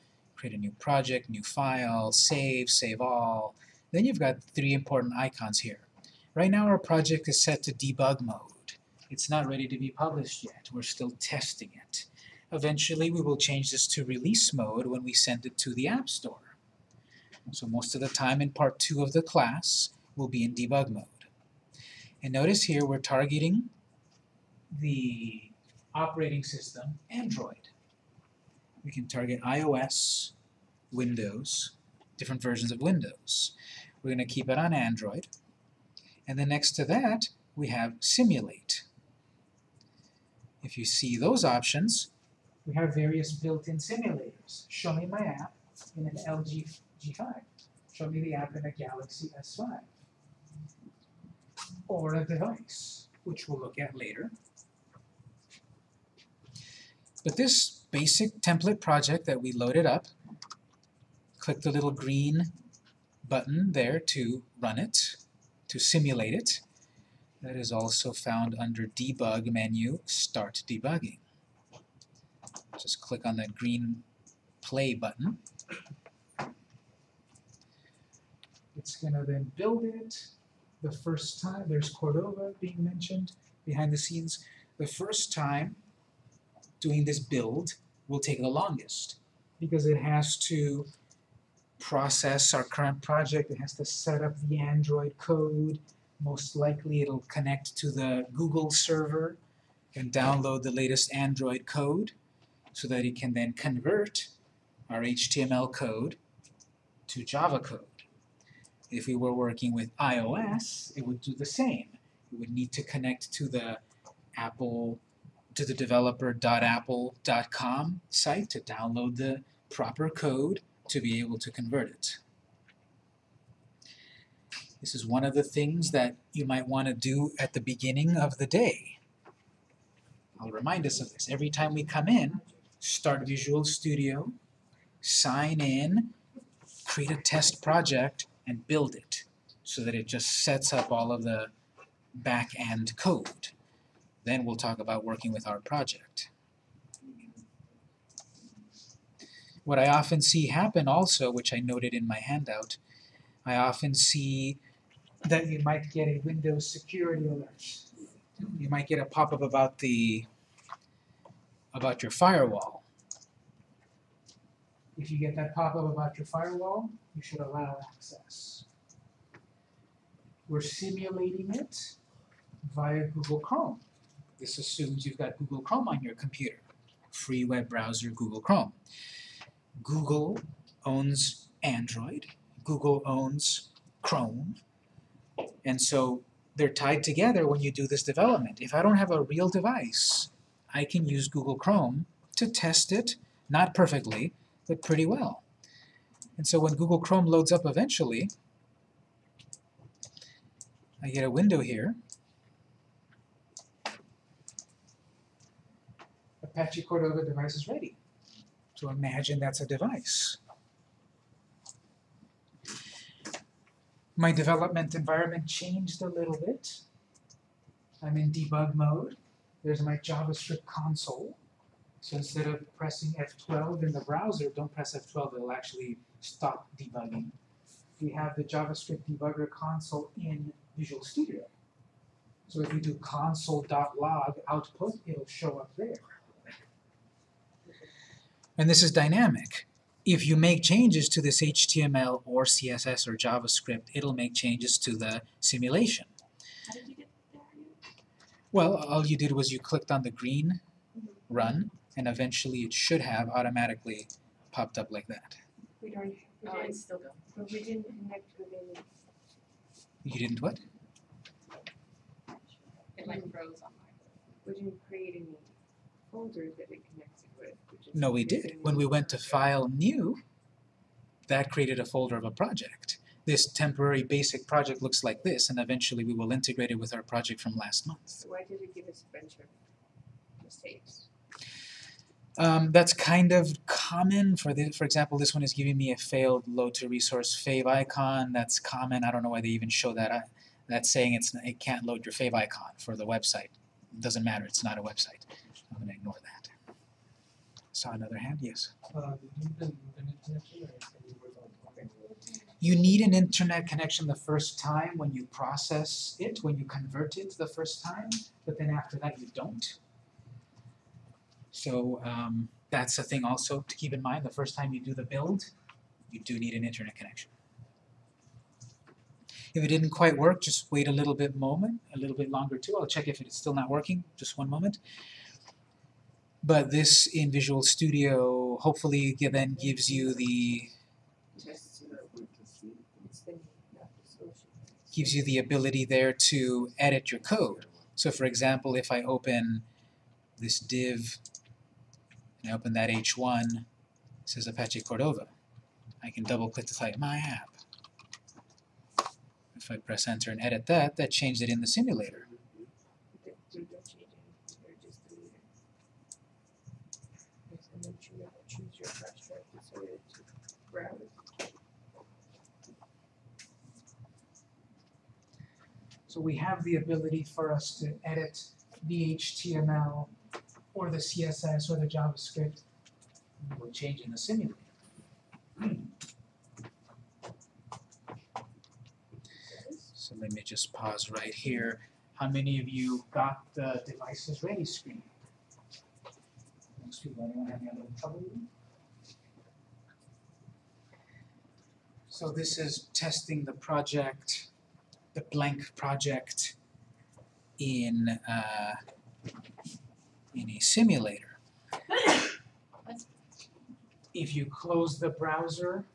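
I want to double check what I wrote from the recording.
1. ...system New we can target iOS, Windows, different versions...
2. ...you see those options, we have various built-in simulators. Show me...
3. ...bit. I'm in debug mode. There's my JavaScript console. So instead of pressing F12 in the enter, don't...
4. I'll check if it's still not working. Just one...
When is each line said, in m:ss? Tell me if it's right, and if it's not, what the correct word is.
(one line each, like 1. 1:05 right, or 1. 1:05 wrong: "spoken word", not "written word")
1. 0:26 wrong: "Android", not "New"
2. 0:40 right
3. 3:36 wrong: "browser", not "enter"
4. 5:22 right.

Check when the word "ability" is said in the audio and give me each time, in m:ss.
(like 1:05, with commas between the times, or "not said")
5:35, 6:06.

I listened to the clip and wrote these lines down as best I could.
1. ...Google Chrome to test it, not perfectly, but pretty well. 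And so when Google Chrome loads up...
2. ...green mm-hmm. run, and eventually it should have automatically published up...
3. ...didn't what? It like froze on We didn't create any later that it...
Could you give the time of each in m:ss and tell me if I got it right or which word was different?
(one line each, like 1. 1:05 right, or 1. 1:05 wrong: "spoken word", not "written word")
1. 3:11 right
2. 4:10 wrong: "popped", not "published"
3. 4:20 wrong: "folder", not "later".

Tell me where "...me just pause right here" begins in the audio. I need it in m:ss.
6:20.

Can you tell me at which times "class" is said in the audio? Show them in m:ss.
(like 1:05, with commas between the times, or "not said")
0:19.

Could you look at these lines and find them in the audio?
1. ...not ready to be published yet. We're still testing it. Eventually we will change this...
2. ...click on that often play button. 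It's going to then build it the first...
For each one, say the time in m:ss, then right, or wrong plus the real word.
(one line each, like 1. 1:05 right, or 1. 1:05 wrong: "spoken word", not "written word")
1. 0:09 right
2. 1:12 wrong: "green", not "often".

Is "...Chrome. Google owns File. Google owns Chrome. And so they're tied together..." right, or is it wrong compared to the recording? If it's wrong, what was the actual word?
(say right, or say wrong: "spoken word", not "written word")
wrong: "Android", not "File".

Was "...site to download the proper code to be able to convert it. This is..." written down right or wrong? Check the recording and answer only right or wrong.
right.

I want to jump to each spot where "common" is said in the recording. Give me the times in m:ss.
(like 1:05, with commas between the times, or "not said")
4:43, 4:48.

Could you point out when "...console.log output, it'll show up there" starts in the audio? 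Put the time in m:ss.
3:52.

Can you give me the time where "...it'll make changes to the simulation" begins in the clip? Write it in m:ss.
4:03.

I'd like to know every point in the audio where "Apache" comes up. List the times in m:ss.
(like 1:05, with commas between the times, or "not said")
3:26, 5:44.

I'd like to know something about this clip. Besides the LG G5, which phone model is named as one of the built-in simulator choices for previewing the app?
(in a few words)
Galaxy S5.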